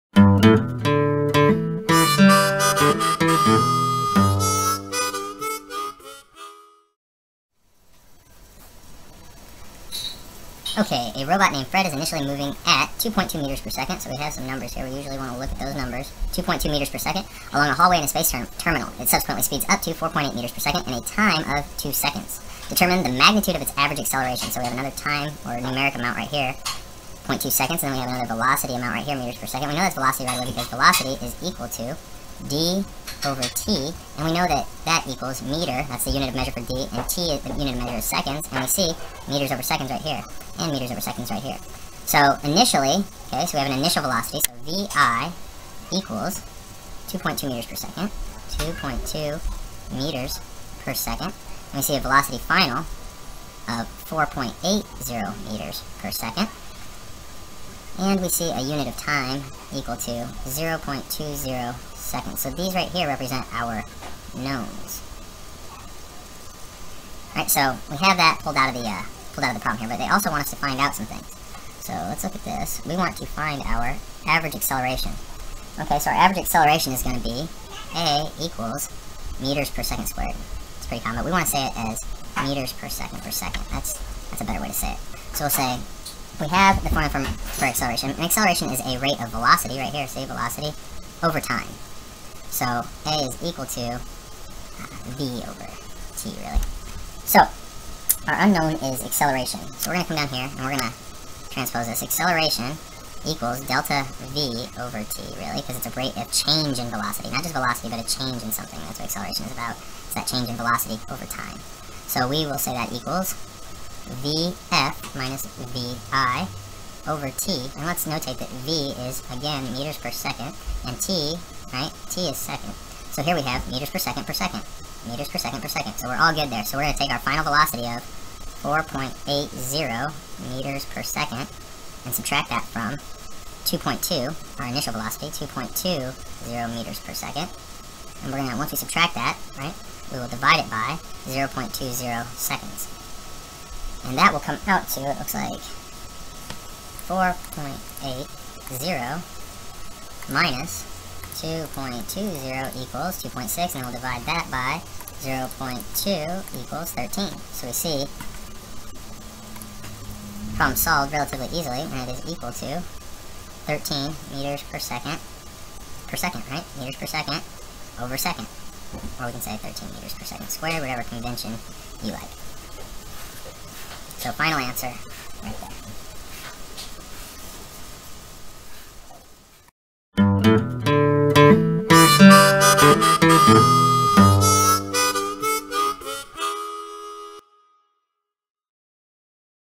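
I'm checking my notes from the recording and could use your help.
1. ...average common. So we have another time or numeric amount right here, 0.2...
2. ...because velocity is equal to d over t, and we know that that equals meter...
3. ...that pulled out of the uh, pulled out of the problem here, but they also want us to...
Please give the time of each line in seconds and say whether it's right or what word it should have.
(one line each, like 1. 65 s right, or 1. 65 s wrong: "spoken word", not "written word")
1. 23 s wrong: "acceleration", not "common"
2. 30 s right
3. 68 s right.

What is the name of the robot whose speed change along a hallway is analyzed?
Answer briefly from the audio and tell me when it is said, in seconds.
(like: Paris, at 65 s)
Fred, at 11 s.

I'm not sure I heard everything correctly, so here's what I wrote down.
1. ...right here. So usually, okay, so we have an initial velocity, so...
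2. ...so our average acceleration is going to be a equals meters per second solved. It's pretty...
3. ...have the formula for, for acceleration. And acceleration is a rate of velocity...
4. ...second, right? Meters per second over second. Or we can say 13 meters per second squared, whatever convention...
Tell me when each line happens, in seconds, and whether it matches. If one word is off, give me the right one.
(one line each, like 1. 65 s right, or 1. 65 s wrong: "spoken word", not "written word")
1. 41 s wrong: "initially", not "usually"
2. 75 s wrong: "squared", not "solved"
3. 86 s right
4. 166 s right.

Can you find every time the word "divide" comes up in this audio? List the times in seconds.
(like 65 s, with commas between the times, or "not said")
140 s, 153 s.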